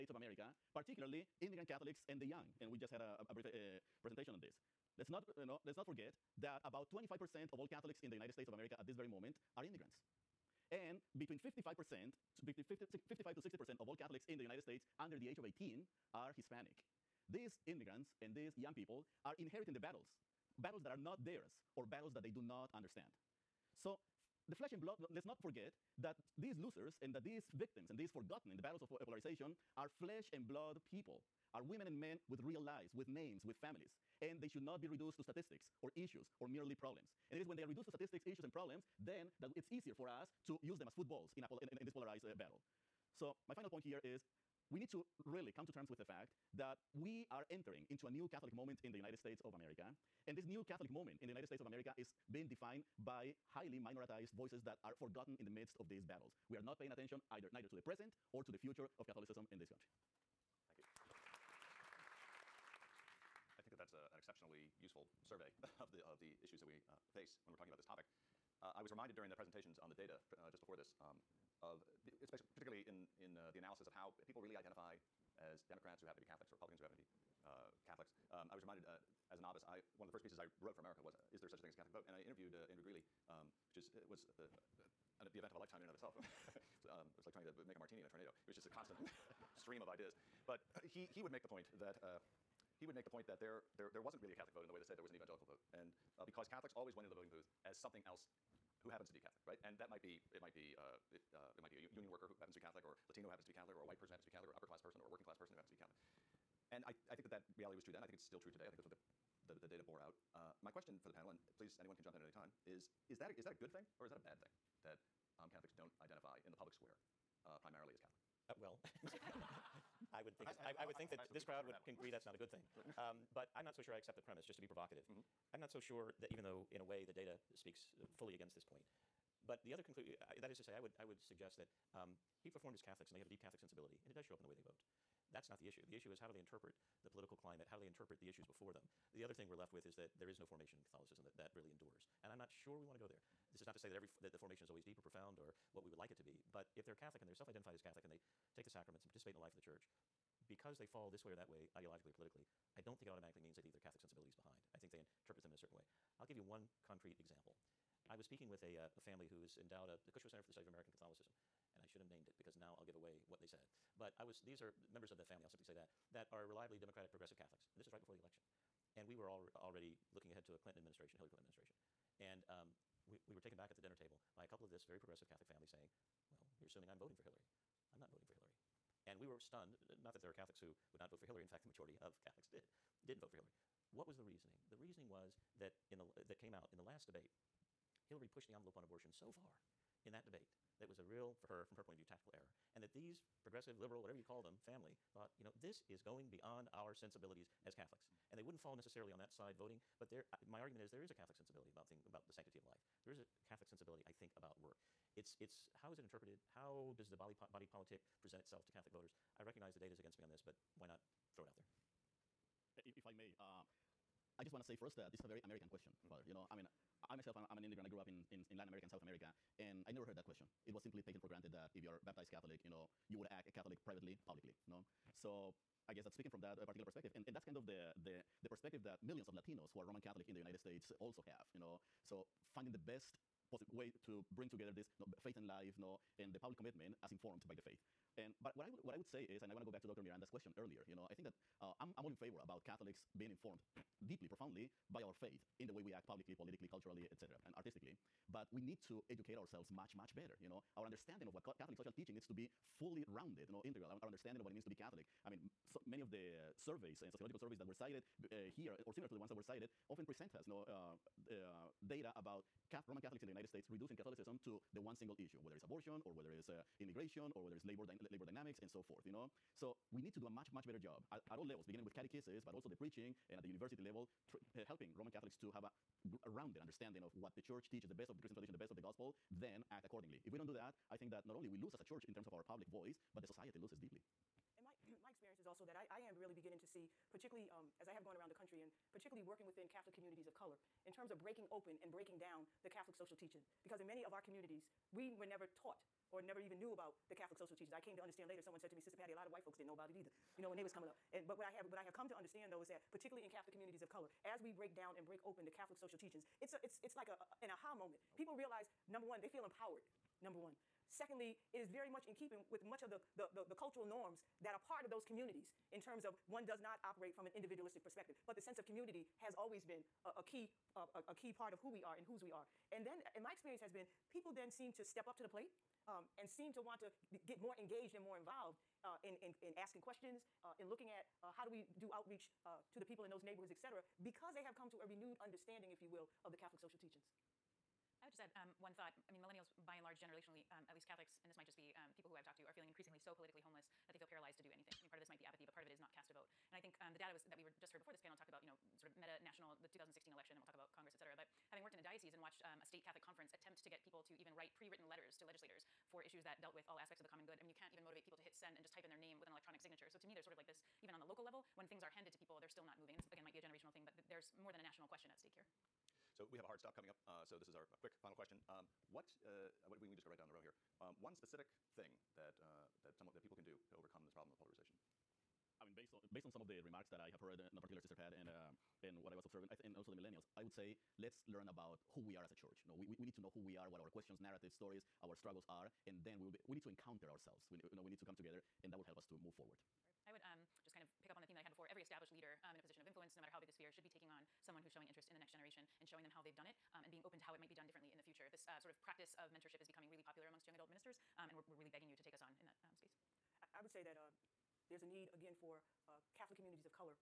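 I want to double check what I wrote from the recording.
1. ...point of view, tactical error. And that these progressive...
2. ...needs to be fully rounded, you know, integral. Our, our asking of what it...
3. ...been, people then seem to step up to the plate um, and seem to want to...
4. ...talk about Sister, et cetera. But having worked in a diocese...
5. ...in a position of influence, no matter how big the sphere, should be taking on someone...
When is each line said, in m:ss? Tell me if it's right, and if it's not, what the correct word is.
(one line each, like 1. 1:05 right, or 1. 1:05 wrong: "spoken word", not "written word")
1. 3:11 right
2. 4:12 wrong: "understanding", not "asking"
3. 5:23 right
4. 5:50 wrong: "Congress", not "Sister"
5. 6:32 right.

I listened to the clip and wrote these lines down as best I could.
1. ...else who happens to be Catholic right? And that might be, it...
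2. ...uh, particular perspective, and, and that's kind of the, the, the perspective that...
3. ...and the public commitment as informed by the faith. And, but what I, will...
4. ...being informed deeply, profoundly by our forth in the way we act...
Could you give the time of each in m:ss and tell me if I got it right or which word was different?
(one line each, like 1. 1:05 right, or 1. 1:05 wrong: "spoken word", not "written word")
1. 1:38 right
2. 3:46 right
3. 3:56 right
4. 4:03 wrong: "faith", not "forth".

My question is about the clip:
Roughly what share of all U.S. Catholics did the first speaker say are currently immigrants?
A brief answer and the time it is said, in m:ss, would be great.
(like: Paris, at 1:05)
25%, at 0:06.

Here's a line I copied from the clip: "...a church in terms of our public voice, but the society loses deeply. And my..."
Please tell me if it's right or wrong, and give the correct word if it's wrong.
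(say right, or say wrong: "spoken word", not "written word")
right.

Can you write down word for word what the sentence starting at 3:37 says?
I grew up in, in, in Latin America and South America, and I never heard that question.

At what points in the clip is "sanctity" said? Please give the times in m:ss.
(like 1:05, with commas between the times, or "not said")
3:22.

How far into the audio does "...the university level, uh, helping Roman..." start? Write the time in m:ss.
4:33.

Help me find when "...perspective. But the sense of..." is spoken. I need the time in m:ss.
5:17.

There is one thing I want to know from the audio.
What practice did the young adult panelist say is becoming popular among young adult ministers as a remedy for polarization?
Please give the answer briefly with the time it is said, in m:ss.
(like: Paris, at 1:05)
mentorship, at 6:39.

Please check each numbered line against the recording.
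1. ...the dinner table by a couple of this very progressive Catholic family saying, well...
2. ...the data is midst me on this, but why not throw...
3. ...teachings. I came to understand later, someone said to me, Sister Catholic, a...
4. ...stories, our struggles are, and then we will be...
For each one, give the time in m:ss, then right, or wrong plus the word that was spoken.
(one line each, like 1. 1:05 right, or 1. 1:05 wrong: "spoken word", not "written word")
1. 2:53 right
2. 3:29 wrong: "against", not "midst"
3. 4:57 wrong: "Patty", not "Catholic"
4. 6:24 right.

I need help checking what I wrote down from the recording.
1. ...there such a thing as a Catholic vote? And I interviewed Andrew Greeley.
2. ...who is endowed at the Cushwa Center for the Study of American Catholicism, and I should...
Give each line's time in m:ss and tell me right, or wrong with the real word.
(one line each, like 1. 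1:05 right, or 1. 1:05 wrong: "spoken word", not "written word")
1. 1:21 right
2. 2:39 right.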